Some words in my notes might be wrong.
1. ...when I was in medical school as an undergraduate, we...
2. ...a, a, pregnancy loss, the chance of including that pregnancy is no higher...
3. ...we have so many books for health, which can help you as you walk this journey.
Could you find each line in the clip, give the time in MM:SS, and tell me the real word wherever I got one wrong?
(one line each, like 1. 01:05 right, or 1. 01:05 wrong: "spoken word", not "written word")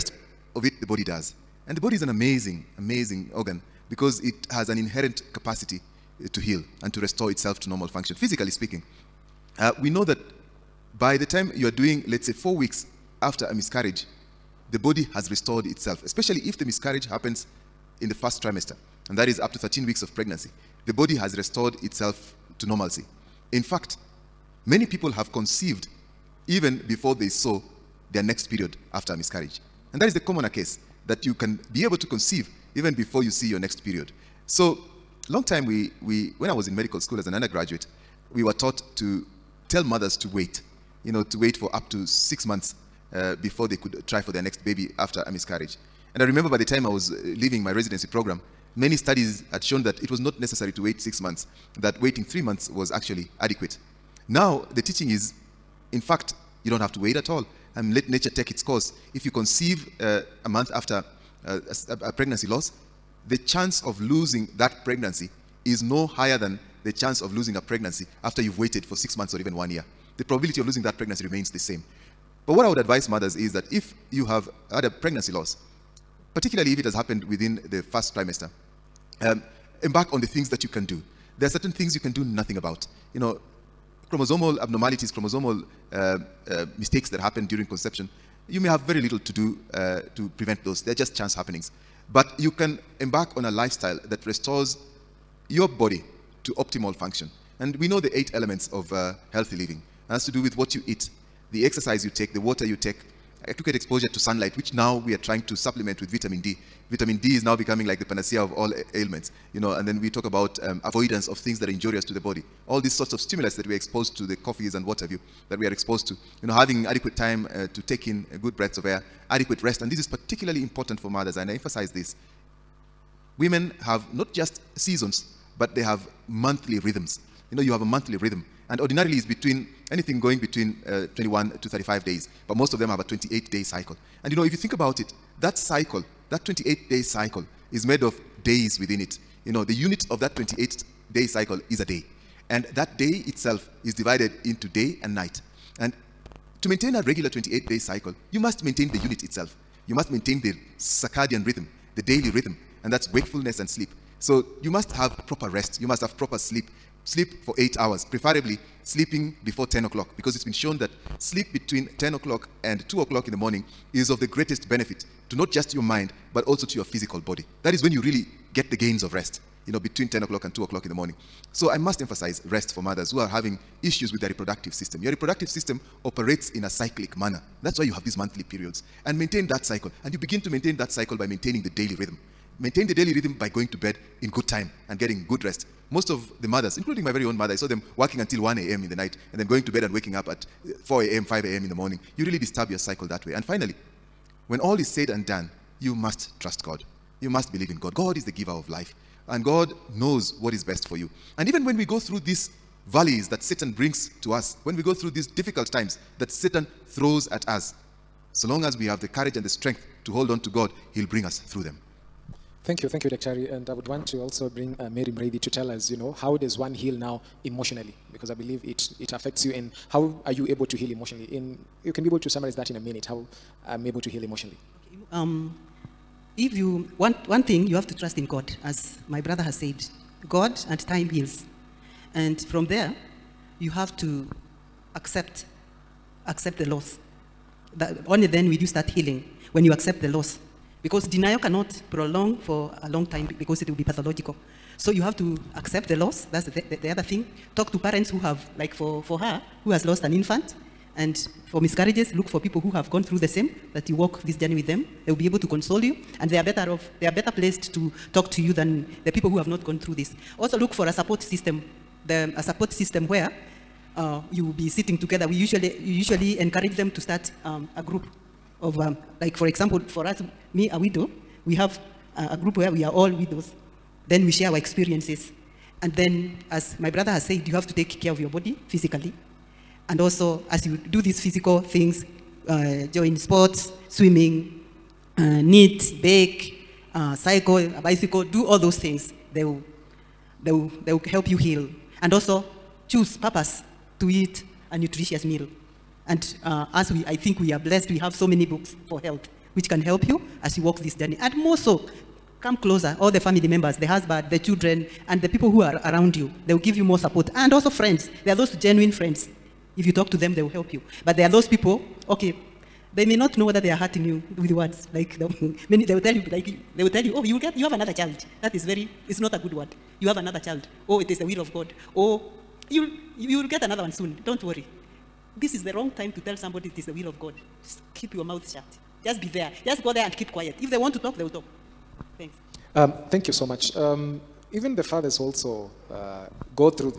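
1. 00:36 right
2. 01:01 wrong: "losing", not "including"
3. 04:57 right.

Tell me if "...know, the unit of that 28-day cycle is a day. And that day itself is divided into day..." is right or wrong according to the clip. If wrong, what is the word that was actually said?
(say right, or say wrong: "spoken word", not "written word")
right.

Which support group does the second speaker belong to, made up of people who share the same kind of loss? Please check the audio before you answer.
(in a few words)
Widows.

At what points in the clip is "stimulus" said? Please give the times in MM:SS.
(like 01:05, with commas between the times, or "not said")
01:53.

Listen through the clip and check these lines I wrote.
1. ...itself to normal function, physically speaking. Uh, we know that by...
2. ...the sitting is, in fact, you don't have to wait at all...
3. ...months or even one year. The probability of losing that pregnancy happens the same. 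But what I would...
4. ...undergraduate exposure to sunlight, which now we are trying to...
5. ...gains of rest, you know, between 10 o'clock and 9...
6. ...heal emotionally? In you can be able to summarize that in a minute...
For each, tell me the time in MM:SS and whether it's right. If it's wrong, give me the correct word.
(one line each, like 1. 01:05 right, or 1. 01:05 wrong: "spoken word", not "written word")
1. 00:07 right
2. 00:54 wrong: "teaching", not "sitting"
3. 01:09 wrong: "remains", not "happens"
4. 01:43 wrong: "adequate", not "undergraduate"
5. 02:48 wrong: "2", not "9"
6. 03:40 right.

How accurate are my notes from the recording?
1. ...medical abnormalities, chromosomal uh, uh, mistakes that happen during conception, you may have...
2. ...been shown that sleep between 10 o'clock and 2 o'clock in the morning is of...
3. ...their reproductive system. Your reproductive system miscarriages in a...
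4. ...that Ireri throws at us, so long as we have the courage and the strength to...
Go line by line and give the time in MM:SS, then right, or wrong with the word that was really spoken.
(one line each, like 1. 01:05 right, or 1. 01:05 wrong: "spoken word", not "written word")
1. 01:24 wrong: "chromosomal", not "medical"
2. 02:40 right
3. 02:54 wrong: "operates", not "miscarriages"
4. 03:26 wrong: "Satan", not "Ireri".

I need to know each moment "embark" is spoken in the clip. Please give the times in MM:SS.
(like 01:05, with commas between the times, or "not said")
01:19, 01:33.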